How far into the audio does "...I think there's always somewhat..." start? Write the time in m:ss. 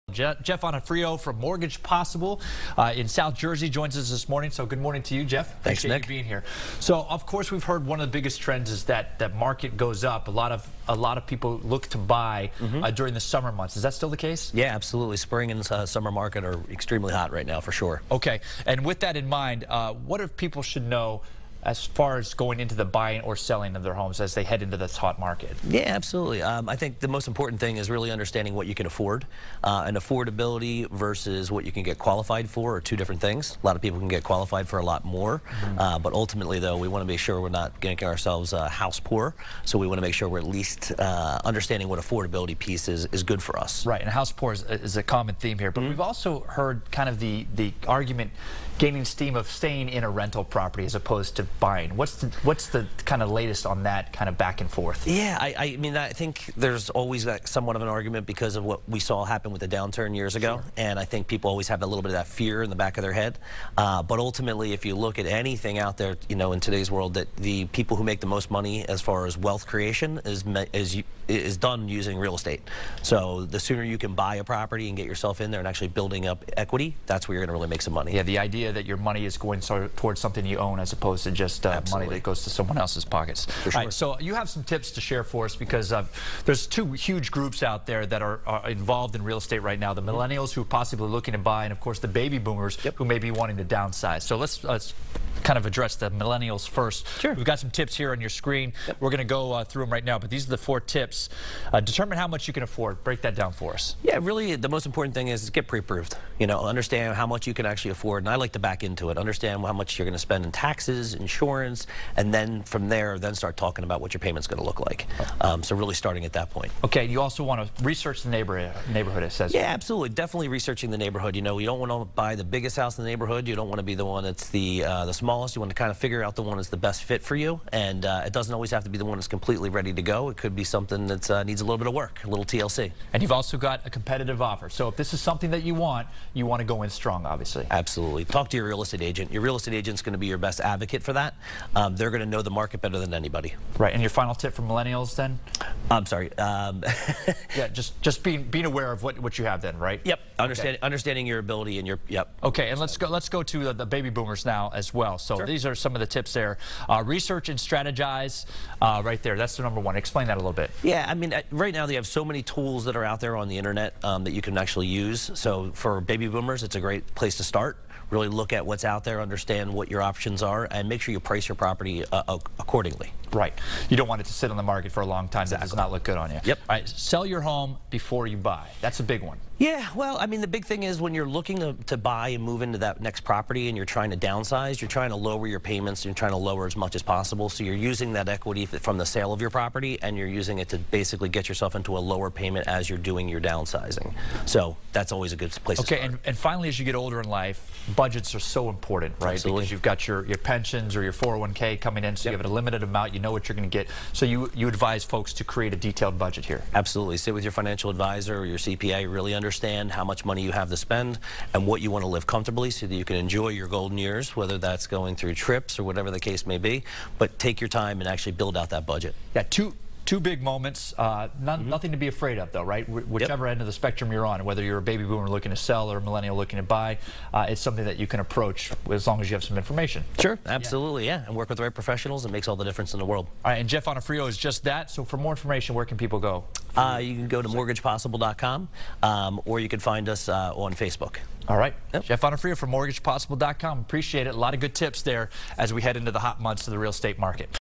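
0:55.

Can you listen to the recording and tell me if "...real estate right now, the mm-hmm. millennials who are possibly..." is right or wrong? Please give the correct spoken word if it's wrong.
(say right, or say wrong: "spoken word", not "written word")
right.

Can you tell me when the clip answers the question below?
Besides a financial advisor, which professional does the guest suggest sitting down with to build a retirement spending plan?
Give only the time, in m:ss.
3:28.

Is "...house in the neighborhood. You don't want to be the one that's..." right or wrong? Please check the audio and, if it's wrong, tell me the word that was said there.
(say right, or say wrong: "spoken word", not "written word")
right.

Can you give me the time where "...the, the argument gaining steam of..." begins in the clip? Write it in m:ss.
0:47.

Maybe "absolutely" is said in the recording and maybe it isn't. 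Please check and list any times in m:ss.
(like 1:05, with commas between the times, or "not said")
0:14, 0:25, 1:59, 2:17, 3:19, 3:26, 3:50.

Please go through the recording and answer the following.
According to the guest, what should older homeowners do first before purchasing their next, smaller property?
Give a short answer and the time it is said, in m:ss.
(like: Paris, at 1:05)
Sell your home, at 2:56.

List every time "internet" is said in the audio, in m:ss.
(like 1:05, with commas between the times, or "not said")
2:43.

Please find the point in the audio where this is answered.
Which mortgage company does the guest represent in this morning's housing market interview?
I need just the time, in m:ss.
0:01.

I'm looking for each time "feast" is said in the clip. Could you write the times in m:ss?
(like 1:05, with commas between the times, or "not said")
not said.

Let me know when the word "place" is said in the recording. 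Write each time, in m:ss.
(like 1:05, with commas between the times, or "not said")
2:47, 3:15.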